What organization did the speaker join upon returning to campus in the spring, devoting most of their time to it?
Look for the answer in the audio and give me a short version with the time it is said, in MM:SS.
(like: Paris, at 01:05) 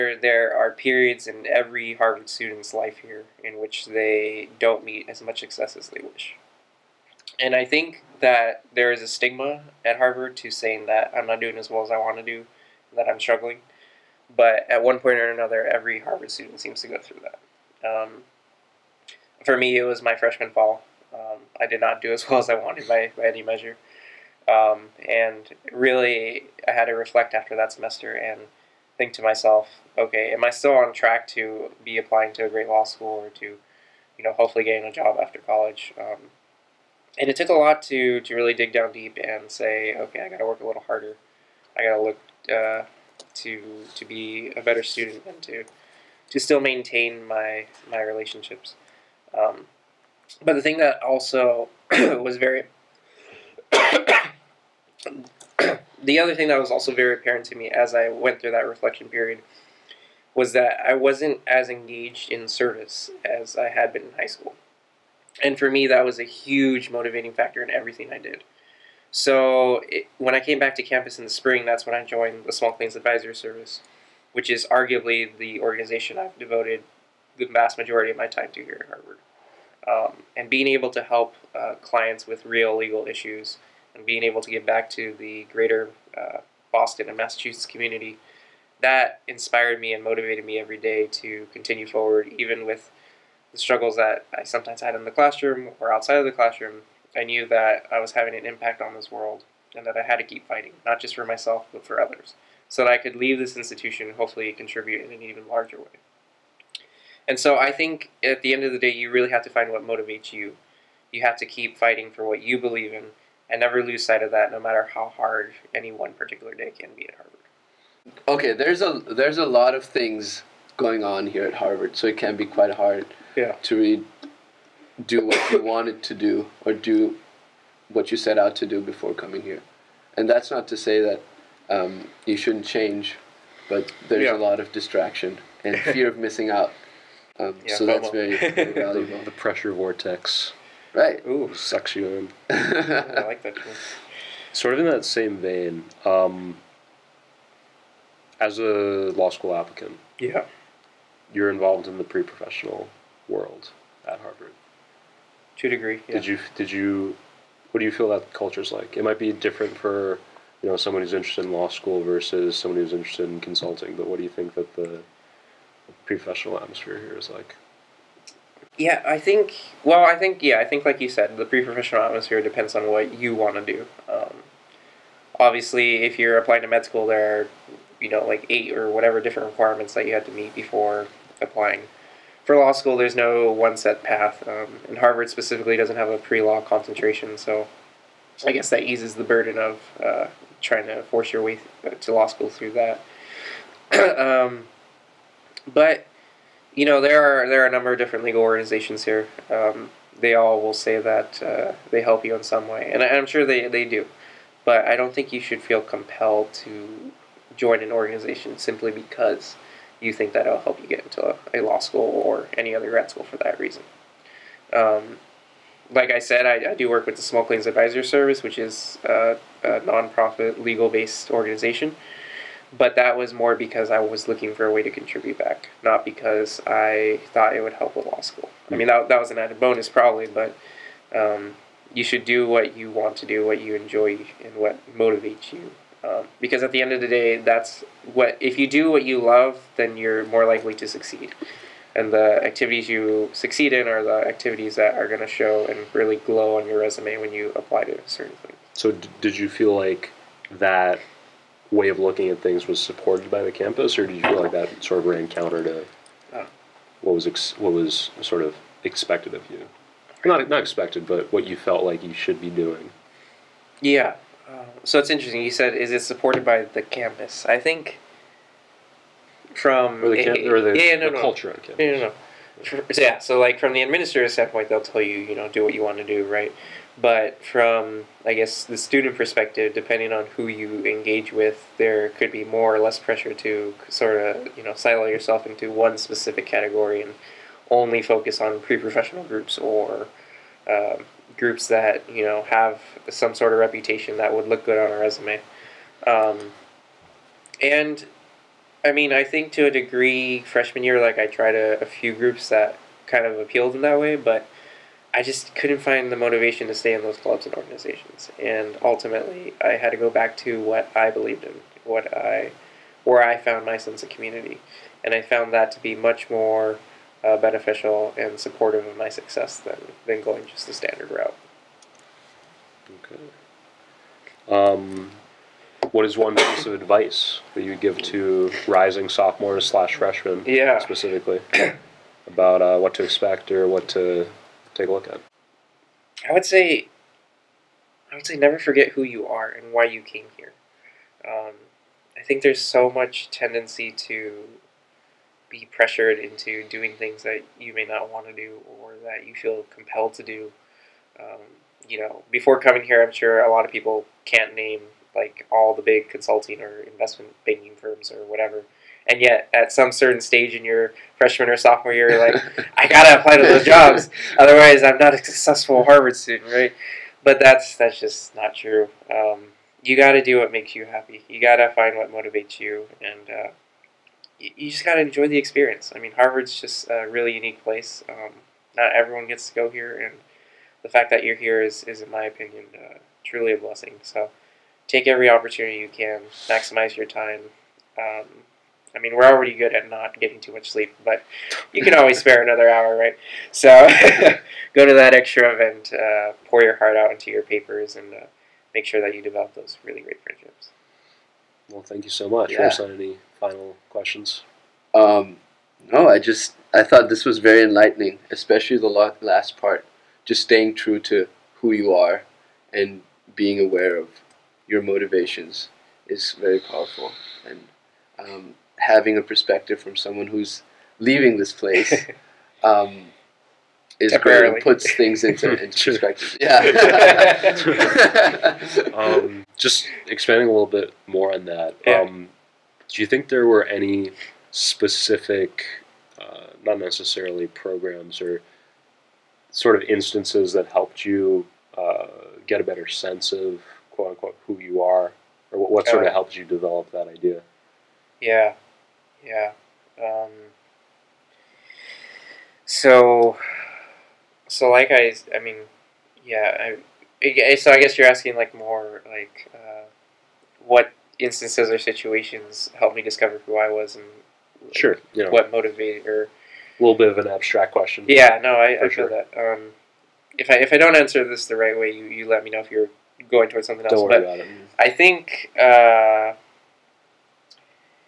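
Small Claims Advisory Service, at 01:12.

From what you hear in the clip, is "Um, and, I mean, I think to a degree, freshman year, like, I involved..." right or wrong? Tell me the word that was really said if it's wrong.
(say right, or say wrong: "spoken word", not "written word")
wrong: "tried", not "involved".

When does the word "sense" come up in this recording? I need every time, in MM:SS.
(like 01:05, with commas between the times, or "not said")
05:13, 07:22.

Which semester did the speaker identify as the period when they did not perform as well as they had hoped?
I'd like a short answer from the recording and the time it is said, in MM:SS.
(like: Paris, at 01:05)
Freshman fall, at 00:20.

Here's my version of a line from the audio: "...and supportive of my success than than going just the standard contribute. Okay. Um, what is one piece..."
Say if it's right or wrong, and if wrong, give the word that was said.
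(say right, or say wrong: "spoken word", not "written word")
wrong: "route", not "contribute".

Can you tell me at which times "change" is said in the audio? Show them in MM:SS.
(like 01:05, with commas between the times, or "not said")
02:12.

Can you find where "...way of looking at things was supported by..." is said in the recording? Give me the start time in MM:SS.
04:11.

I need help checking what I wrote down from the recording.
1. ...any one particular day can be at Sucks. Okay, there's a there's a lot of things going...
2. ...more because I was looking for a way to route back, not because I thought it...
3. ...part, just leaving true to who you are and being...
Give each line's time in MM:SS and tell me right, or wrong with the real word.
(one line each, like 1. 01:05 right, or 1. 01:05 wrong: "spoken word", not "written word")
1. 01:55 wrong: "Harvard", not "Sucks"
2. 03:43 wrong: "contribute", not "route"
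3. 06:49 wrong: "staying", not "leaving".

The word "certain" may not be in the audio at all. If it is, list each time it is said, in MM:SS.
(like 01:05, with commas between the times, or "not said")
04:08, 05:59.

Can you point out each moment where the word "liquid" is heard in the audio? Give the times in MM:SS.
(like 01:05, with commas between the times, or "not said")
not said.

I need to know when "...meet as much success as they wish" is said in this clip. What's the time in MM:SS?
00:04.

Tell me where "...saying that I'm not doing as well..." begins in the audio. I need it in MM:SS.
00:10.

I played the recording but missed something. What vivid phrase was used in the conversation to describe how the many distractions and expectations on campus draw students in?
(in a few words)
The pressure vortex.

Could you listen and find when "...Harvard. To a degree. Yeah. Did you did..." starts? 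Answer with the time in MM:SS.
02:34.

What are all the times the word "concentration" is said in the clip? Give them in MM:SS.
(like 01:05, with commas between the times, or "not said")
03:06.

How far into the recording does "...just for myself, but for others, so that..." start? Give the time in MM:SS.
01:40.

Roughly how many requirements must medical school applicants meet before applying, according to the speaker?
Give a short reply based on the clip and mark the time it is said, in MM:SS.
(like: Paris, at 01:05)
8, at 02:58.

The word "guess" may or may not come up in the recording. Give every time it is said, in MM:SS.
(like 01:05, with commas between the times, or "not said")
03:08, 04:38, 07:37.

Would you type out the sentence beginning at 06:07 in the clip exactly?
But that's that's just not true.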